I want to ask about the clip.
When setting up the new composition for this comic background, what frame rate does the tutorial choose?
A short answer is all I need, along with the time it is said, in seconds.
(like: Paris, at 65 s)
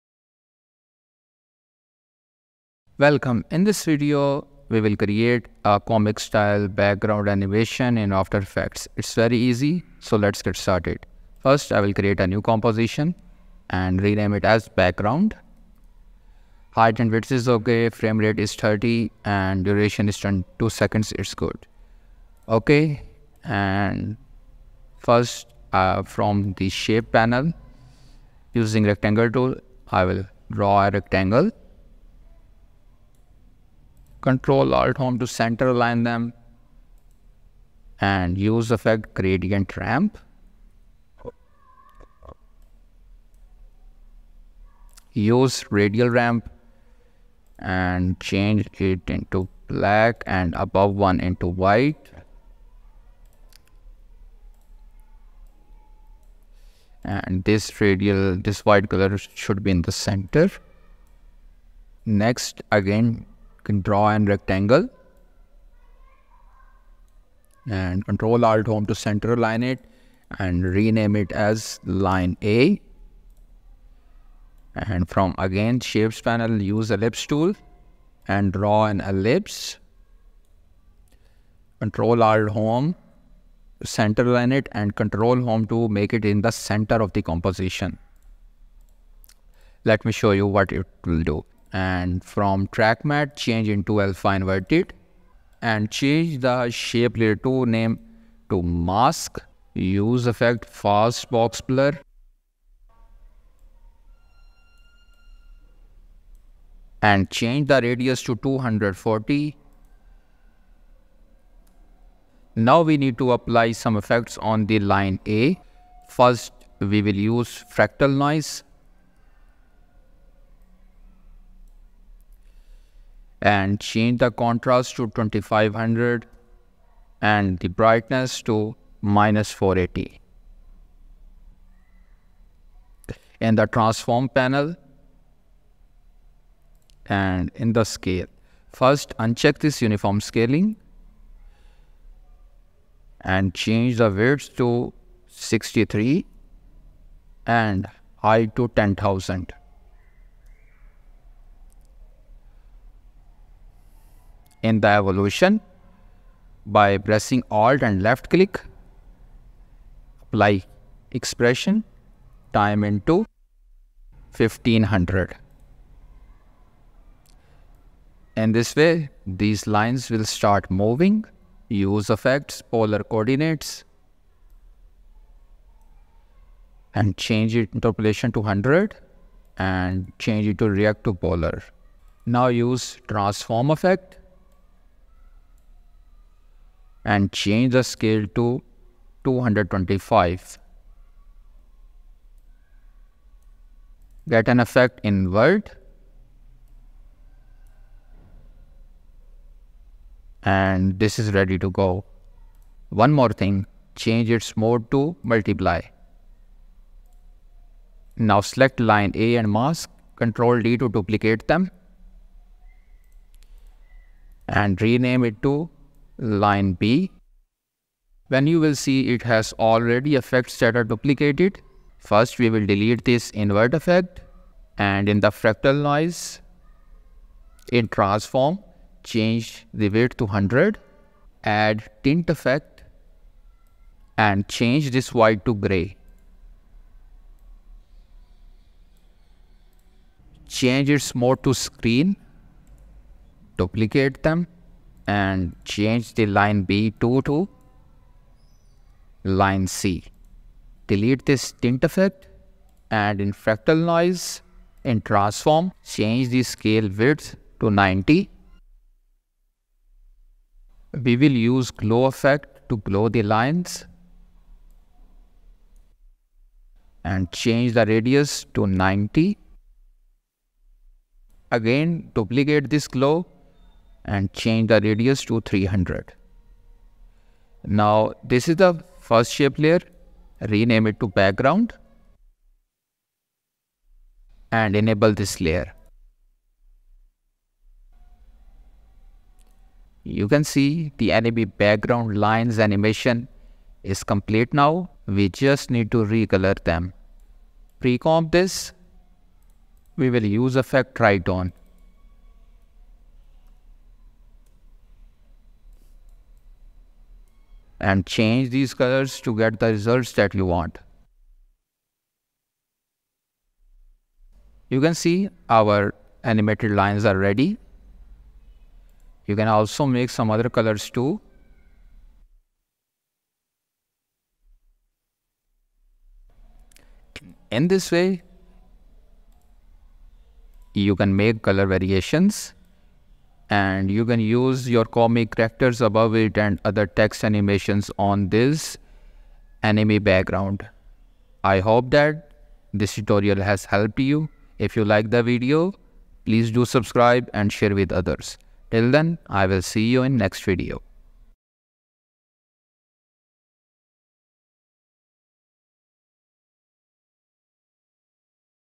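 30, at 17 s.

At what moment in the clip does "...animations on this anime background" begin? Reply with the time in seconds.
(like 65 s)
337 s.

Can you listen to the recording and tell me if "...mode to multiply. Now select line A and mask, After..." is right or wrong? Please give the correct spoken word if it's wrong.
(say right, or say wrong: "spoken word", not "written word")
wrong: "Control", not "After".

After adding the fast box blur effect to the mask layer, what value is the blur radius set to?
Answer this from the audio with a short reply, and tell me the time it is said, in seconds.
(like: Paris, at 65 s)
240, at 107 s.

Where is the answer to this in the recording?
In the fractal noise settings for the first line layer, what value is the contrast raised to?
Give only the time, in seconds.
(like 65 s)
124 s.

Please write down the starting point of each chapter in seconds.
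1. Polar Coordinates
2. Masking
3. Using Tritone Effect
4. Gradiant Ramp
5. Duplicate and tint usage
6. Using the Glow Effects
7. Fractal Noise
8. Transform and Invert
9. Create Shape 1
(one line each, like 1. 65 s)
1. 170 s
2. 100 s
3. 319 s
4. 60 s
5. 210 s
6. 280 s
7. 131 s
8. 190 s
9. 36 s.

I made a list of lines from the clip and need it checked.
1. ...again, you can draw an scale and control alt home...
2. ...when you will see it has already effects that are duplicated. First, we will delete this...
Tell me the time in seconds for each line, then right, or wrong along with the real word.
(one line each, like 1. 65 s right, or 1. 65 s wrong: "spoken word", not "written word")
1. 62 s wrong: "rectangle", not "scale"
2. 218 s right.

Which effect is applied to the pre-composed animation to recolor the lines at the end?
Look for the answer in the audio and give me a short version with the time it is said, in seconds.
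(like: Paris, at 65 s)
Tritone, at 300 s.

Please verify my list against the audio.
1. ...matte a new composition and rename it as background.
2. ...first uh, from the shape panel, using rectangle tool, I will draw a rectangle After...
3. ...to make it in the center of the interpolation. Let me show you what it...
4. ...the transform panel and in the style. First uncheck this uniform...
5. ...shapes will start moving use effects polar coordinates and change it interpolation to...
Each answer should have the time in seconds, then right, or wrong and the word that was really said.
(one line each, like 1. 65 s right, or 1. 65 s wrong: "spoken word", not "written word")
1. 11 s wrong: "create", not "matte"
2. 24 s wrong: "Control", not "After"
3. 85 s wrong: "composition", not "interpolation"
4. 133 s wrong: "scale", not "style"
5. 169 s wrong: "lines", not "shapes".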